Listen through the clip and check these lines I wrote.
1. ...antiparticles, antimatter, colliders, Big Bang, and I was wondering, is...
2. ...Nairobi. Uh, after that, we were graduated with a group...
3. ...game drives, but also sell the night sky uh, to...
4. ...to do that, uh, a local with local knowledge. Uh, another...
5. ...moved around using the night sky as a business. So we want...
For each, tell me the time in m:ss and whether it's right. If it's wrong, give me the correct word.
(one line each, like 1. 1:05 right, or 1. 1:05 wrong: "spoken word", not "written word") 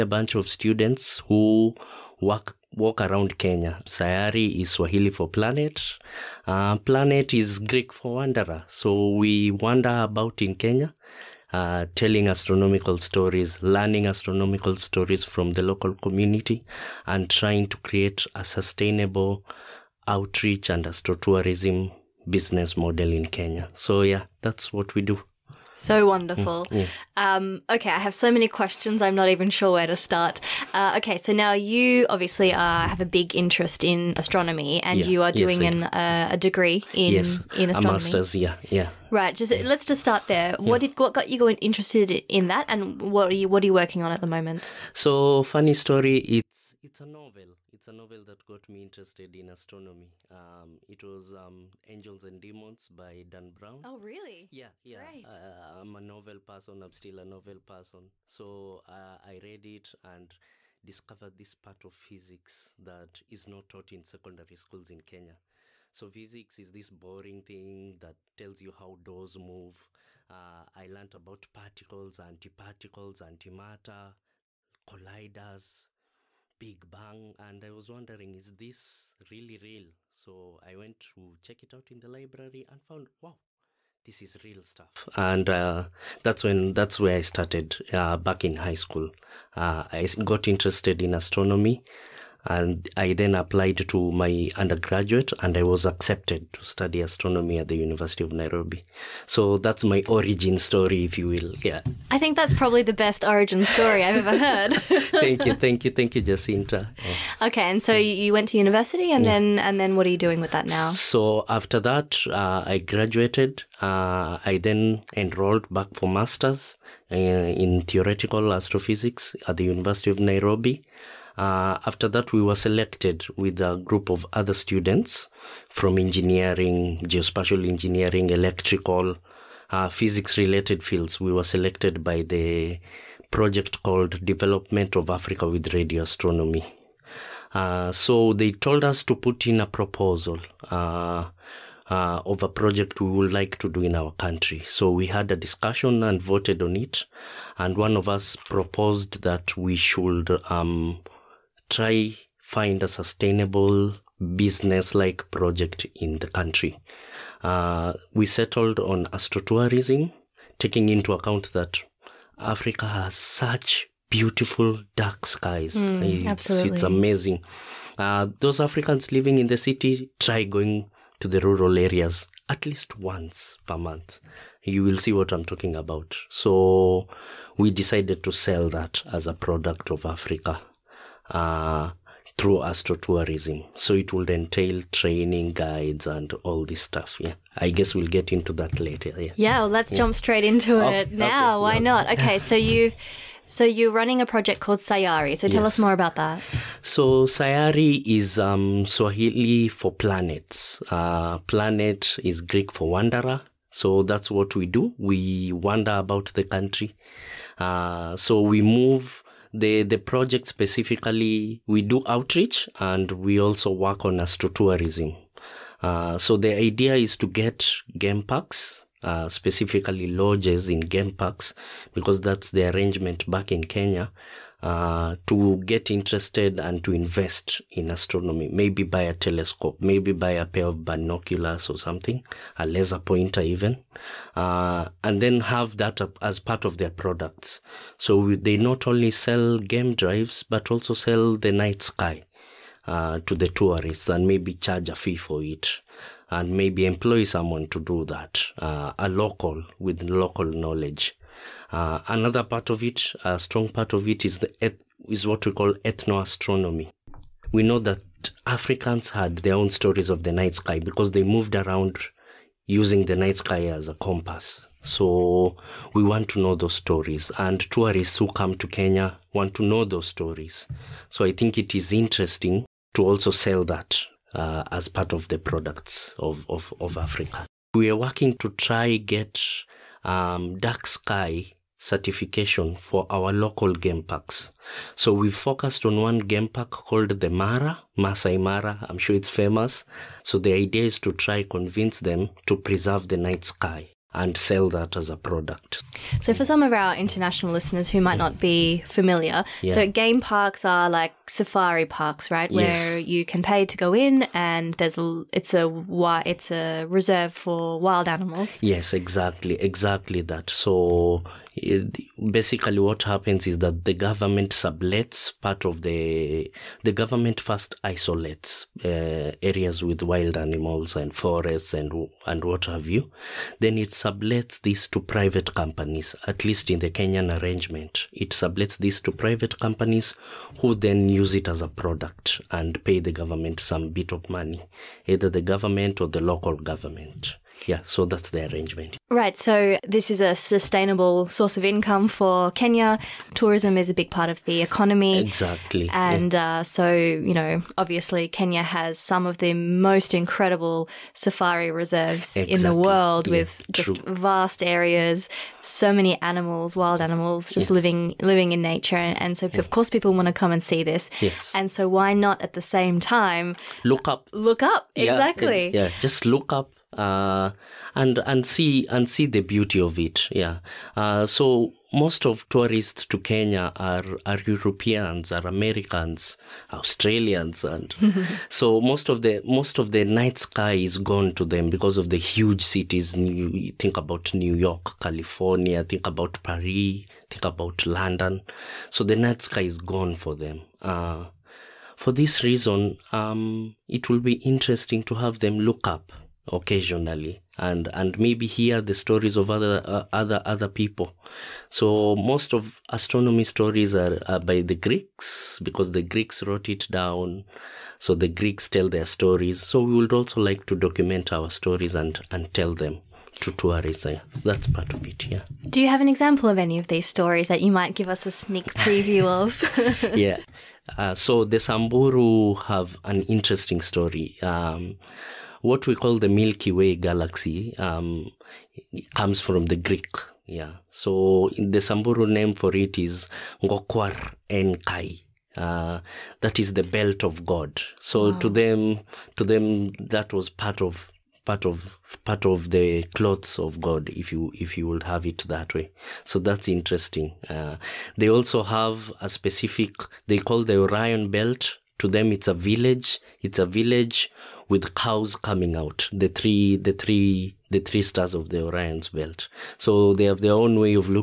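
1. 1:12 right
2. 2:00 wrong: "selected", not "graduated"
3. 3:59 right
4. 4:07 right
5. 4:21 wrong: "compass", not "business".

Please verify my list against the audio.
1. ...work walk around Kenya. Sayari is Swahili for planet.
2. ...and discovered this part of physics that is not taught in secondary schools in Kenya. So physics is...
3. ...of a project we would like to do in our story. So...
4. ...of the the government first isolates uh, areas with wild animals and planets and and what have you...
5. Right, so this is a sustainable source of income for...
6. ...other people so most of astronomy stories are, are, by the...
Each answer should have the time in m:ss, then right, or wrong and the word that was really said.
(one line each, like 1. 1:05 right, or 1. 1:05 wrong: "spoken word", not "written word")
1. 0:02 right
2. 1:00 right
3. 2:22 wrong: "country", not "story"
4. 5:15 wrong: "forests", not "planets"
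5. 5:39 right
6. 6:40 right.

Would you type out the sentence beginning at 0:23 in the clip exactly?
So yeah, that's what we do.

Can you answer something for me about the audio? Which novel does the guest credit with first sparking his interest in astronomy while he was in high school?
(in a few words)
Angels and Demons.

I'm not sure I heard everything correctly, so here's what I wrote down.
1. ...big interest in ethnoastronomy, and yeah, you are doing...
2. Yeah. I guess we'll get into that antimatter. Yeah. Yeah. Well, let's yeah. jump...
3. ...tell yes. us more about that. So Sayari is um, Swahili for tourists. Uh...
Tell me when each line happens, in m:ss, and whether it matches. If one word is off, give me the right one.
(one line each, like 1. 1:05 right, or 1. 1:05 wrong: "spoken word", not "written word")
1. 0:33 wrong: "astronomy", not "ethnoastronomy"
2. 3:07 wrong: "later", not "antimatter"
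3. 3:15 wrong: "planets", not "tourists".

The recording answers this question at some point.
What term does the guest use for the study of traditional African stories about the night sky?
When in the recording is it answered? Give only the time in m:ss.
4:15.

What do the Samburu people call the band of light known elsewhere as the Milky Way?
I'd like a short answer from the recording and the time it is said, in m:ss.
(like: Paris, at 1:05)
Ngokwar Enkai, at 7:13.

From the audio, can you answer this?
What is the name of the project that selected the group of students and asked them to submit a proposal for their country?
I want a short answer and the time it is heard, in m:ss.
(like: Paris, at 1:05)
Development of Africa with Radio Astronomy, at 2:14.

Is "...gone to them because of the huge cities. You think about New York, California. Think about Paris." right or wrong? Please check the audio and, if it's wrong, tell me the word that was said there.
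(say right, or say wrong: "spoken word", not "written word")
right.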